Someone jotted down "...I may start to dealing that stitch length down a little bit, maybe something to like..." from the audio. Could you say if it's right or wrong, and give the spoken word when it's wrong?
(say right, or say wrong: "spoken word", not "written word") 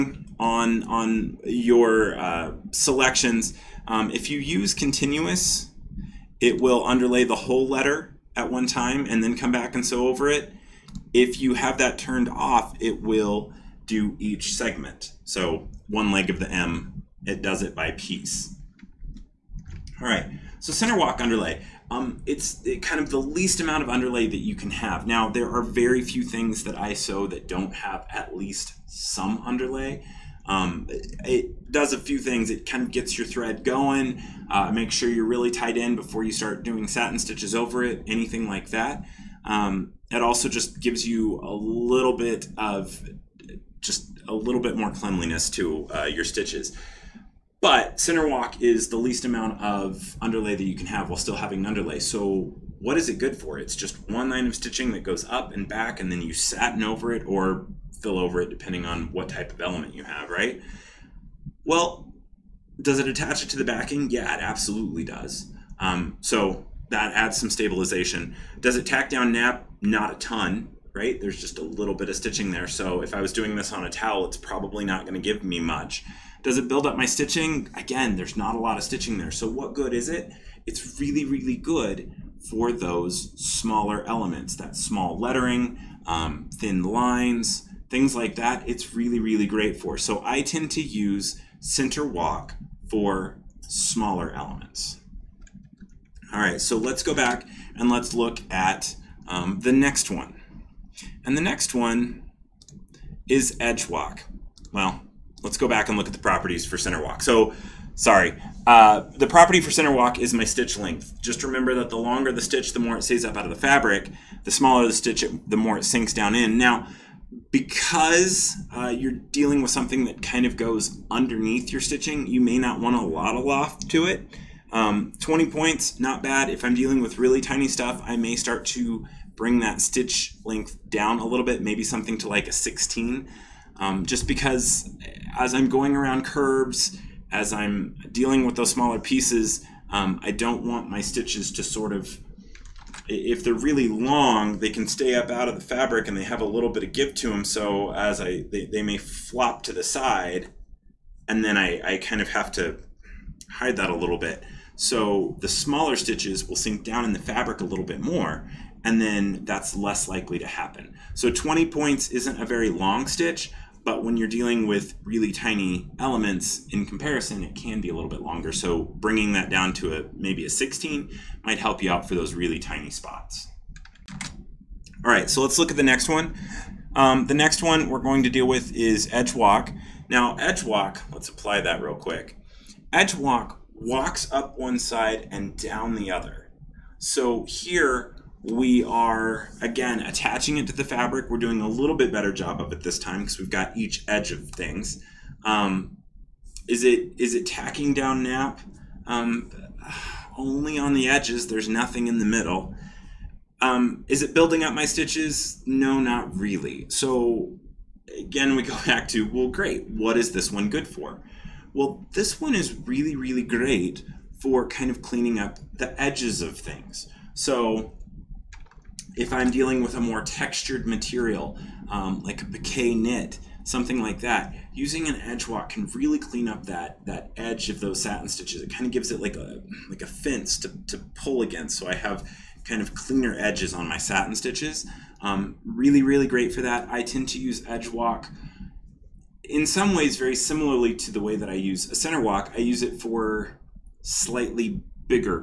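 wrong: "bring", not "dealing".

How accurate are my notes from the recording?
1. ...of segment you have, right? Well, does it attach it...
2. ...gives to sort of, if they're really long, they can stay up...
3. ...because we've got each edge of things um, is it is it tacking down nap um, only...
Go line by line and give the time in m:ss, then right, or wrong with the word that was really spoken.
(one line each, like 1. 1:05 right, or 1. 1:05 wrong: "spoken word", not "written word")
1. 0:59 wrong: "element", not "segment"
2. 2:21 wrong: "stitches", not "gives"
3. 3:13 right.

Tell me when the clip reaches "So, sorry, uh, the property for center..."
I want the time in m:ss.
1:47.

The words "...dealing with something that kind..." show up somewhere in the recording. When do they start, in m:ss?
1:59.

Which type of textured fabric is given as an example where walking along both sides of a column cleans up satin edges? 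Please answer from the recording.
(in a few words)
piqué knit.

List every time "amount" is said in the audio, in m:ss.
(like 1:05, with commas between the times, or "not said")
0:23, 0:49.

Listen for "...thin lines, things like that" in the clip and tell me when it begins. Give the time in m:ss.
1:26.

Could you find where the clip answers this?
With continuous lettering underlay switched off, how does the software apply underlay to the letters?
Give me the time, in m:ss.
0:14.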